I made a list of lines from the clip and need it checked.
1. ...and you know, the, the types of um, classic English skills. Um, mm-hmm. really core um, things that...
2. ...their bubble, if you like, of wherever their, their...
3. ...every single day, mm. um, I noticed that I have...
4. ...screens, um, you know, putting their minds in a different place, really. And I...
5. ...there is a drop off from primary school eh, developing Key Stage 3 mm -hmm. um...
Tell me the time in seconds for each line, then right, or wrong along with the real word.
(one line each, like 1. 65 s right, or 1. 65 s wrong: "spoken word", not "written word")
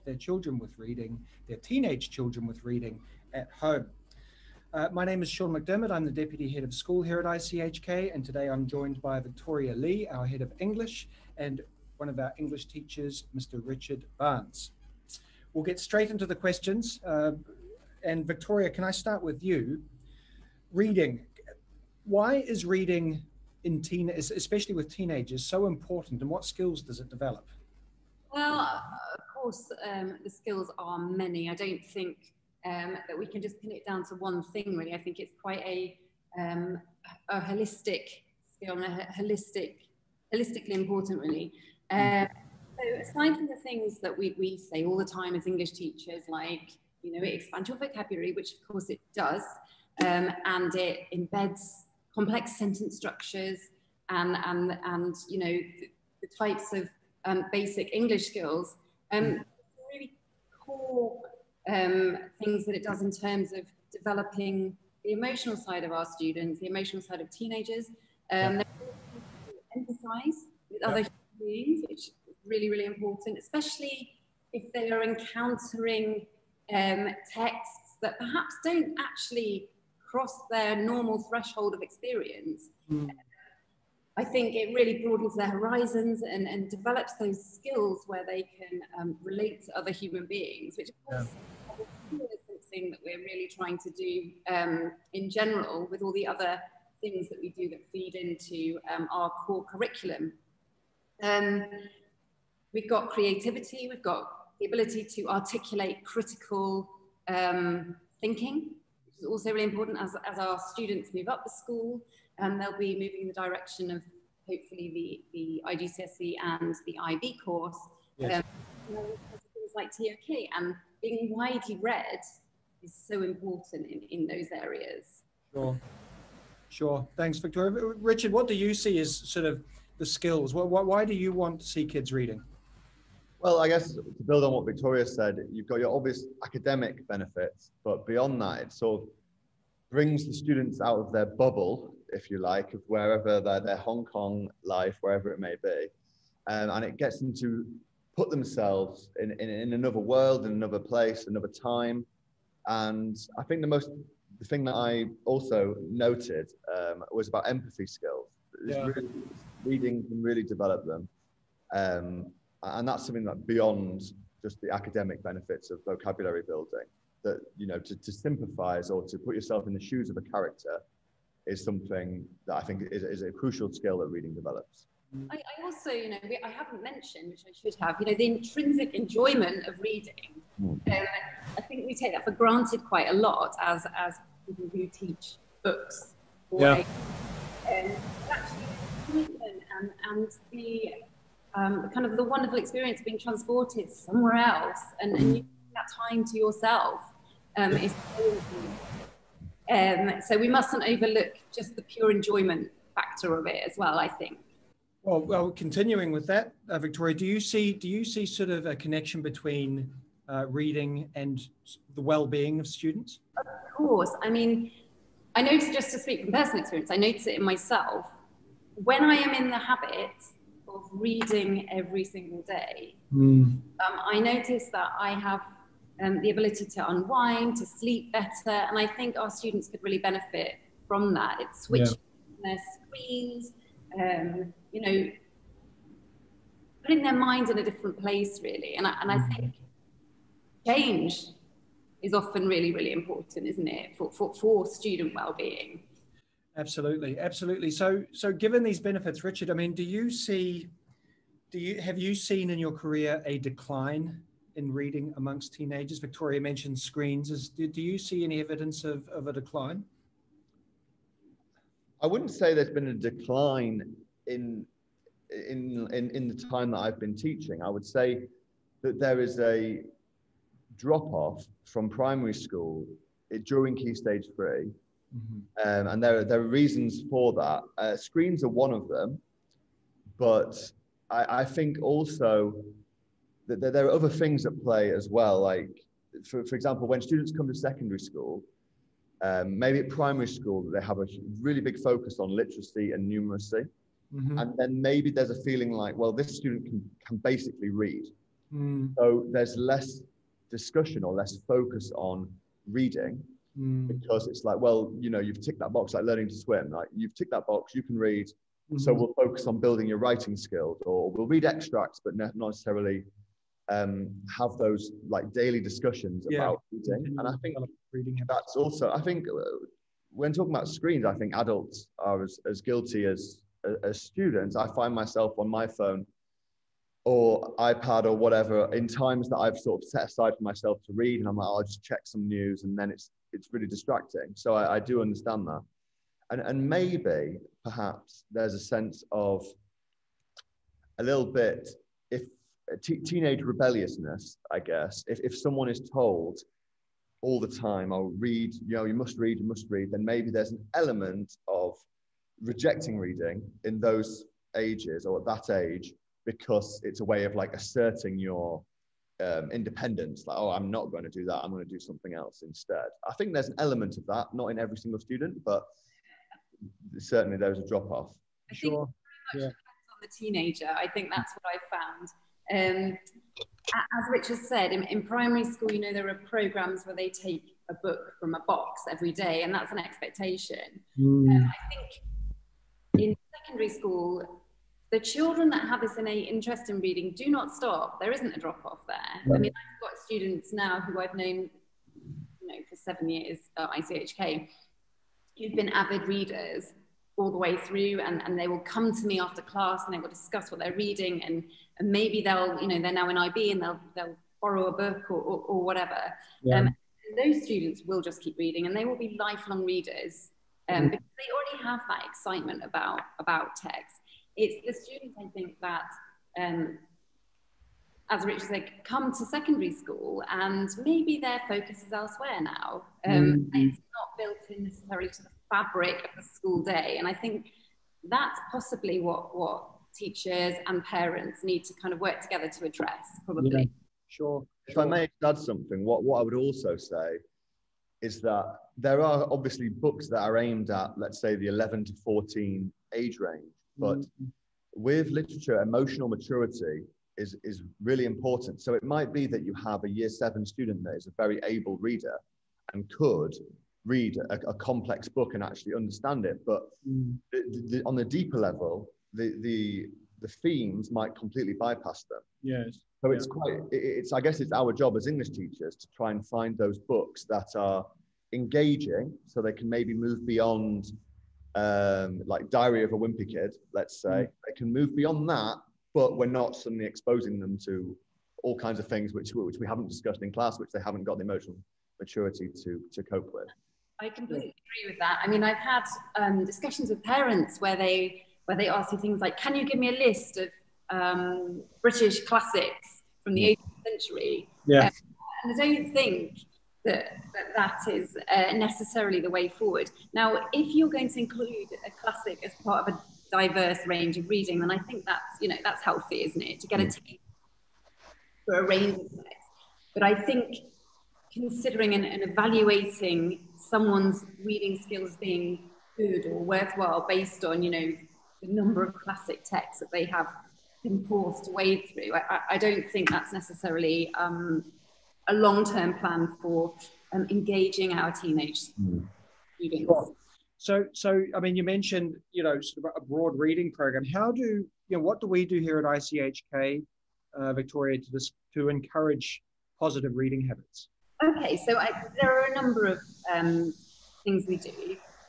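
1. 54 s wrong: "basic", not "classic"
2. 141 s right
3. 221 s right
4. 232 s right
5. 268 s wrong: "during", not "developing".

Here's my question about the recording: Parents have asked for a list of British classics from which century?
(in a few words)
18th century.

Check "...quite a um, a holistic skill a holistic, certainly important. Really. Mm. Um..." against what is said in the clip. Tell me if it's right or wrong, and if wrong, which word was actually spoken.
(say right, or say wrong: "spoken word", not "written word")
wrong: "holistically", not "certainly".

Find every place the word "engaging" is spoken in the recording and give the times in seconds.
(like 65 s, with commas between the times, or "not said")
468 s, 527 s.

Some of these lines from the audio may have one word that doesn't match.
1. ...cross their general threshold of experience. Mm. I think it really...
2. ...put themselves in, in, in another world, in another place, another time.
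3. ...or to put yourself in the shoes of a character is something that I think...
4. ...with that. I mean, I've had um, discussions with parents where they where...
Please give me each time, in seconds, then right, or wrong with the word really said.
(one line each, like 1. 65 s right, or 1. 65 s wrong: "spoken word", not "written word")
1. 80 s wrong: "normal", not "general"
2. 148 s right
3. 168 s right
4. 484 s right.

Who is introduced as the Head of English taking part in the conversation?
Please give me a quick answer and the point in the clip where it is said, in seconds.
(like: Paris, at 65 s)
Victoria Lee, at 9 s.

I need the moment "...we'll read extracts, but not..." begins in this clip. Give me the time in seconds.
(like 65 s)
311 s.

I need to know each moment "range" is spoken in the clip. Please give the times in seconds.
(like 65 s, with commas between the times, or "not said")
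443 s, 503 s, 508 s.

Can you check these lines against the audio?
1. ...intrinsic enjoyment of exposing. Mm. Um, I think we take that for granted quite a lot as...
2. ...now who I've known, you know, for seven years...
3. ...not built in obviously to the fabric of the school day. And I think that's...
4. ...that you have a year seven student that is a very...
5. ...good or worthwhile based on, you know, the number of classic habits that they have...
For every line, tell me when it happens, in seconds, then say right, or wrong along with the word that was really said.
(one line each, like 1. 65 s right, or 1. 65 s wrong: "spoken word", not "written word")
1. 178 s wrong: "reading", not "exposing"
2. 390 s right
3. 423 s wrong: "necessarily", not "obviously"
4. 449 s right
5. 515 s wrong: "texts", not "habits".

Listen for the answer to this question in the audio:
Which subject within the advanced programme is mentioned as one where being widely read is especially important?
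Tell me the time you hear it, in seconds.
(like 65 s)
119 s.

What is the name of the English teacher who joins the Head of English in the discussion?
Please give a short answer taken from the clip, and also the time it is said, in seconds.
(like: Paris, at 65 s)
Richard Barnes, at 13 s.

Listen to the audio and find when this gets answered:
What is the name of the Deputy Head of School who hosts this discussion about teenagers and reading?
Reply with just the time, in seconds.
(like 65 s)
5 s.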